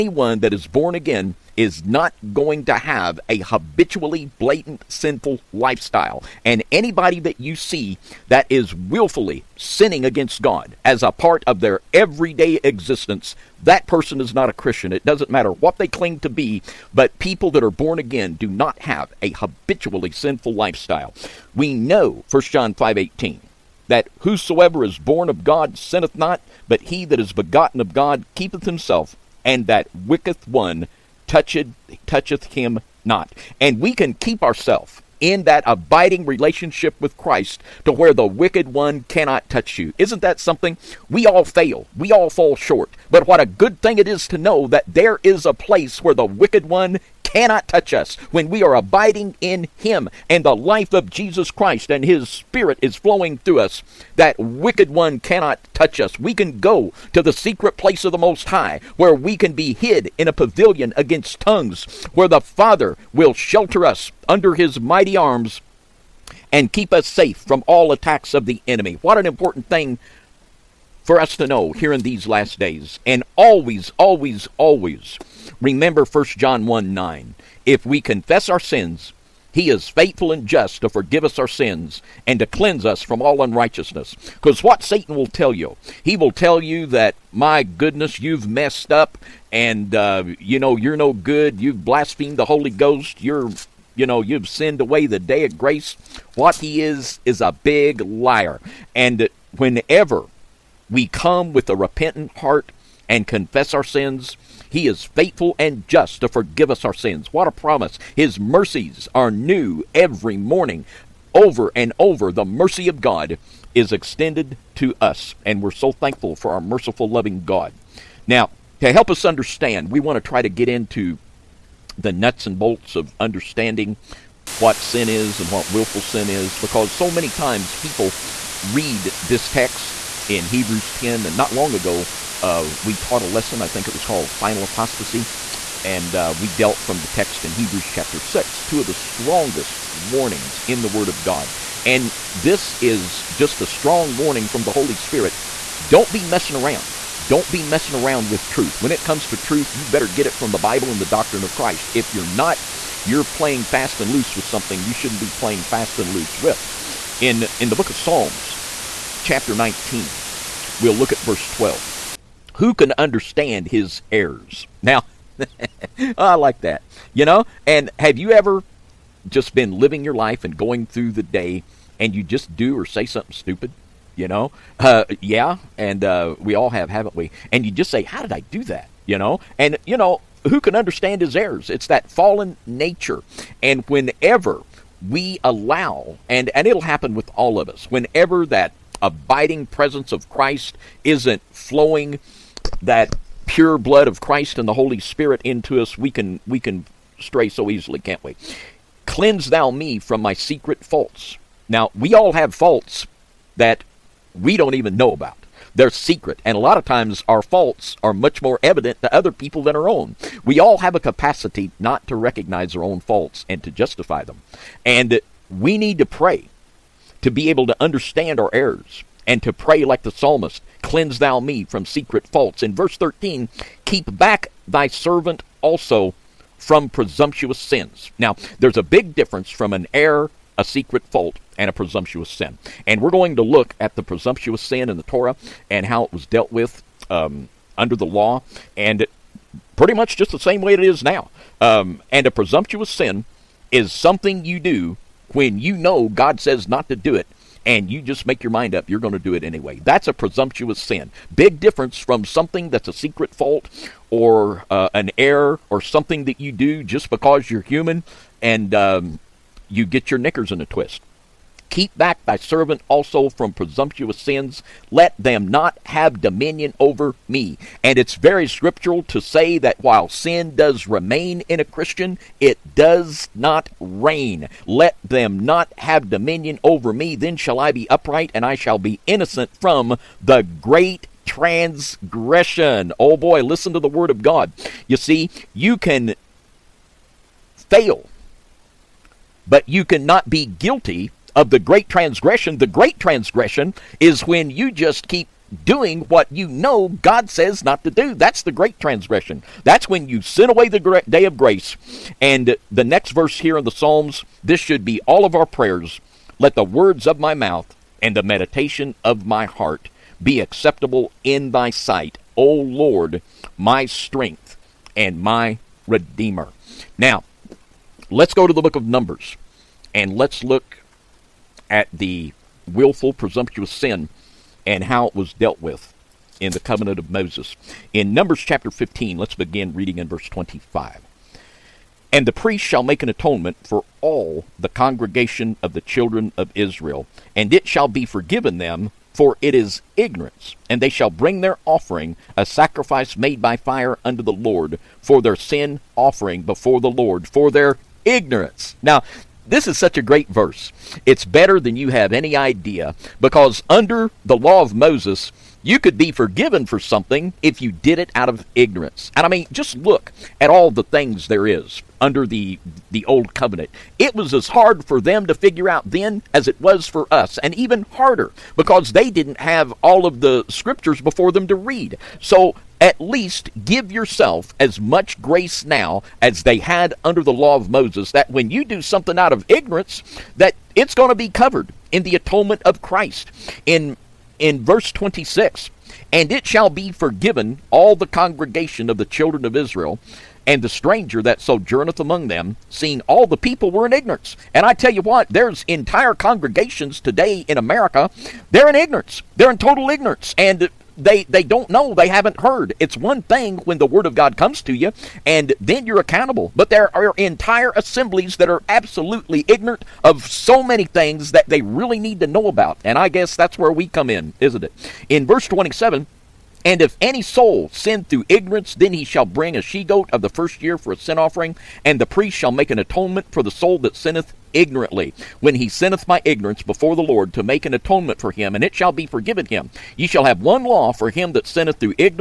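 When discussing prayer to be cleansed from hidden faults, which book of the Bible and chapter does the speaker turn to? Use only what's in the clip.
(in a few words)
Psalms 19.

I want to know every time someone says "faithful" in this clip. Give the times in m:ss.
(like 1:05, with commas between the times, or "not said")
1:19, 1:45.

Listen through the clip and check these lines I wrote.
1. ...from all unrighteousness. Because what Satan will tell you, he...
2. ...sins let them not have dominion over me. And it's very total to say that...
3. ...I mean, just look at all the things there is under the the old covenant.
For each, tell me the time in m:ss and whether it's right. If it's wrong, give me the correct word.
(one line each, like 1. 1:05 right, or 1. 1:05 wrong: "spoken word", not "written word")
1. 1:23 right
2. 4:24 wrong: "scriptural", not "total"
3. 5:59 right.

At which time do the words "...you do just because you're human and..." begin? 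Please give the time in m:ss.
4:16.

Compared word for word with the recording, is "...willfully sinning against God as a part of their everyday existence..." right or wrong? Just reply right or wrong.
right.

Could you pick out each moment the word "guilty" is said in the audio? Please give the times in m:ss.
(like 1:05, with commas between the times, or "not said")
4:50.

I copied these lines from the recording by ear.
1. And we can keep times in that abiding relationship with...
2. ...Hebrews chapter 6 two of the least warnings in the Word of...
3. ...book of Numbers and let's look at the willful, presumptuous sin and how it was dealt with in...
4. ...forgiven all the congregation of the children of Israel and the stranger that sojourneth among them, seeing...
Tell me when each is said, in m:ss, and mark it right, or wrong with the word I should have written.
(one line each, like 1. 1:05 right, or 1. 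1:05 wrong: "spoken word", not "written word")
1. 0:33 wrong: "ourselves", not "times"
2. 2:17 wrong: "strongest", not "least"
3. 5:18 right
4. 6:26 right.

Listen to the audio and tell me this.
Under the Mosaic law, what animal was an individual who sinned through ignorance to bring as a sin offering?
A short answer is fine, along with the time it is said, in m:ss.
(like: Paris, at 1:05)
A she goat, at 6:59.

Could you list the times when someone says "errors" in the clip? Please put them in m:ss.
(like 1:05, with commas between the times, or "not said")
2:44, 3:01, 3:38, 3:49, 4:15.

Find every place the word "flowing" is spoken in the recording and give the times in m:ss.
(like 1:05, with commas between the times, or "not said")
0:52, 3:11.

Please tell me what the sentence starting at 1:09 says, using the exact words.
What an important thing for us to know here in these last days.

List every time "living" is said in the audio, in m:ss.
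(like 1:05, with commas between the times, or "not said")
2:49.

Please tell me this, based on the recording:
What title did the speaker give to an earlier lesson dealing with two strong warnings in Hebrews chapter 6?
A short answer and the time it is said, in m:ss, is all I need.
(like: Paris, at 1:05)
Final apostasy, at 2:14.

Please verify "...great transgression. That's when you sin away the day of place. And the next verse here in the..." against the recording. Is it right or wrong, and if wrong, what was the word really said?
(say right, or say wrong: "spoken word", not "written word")
wrong: "grace", not "place".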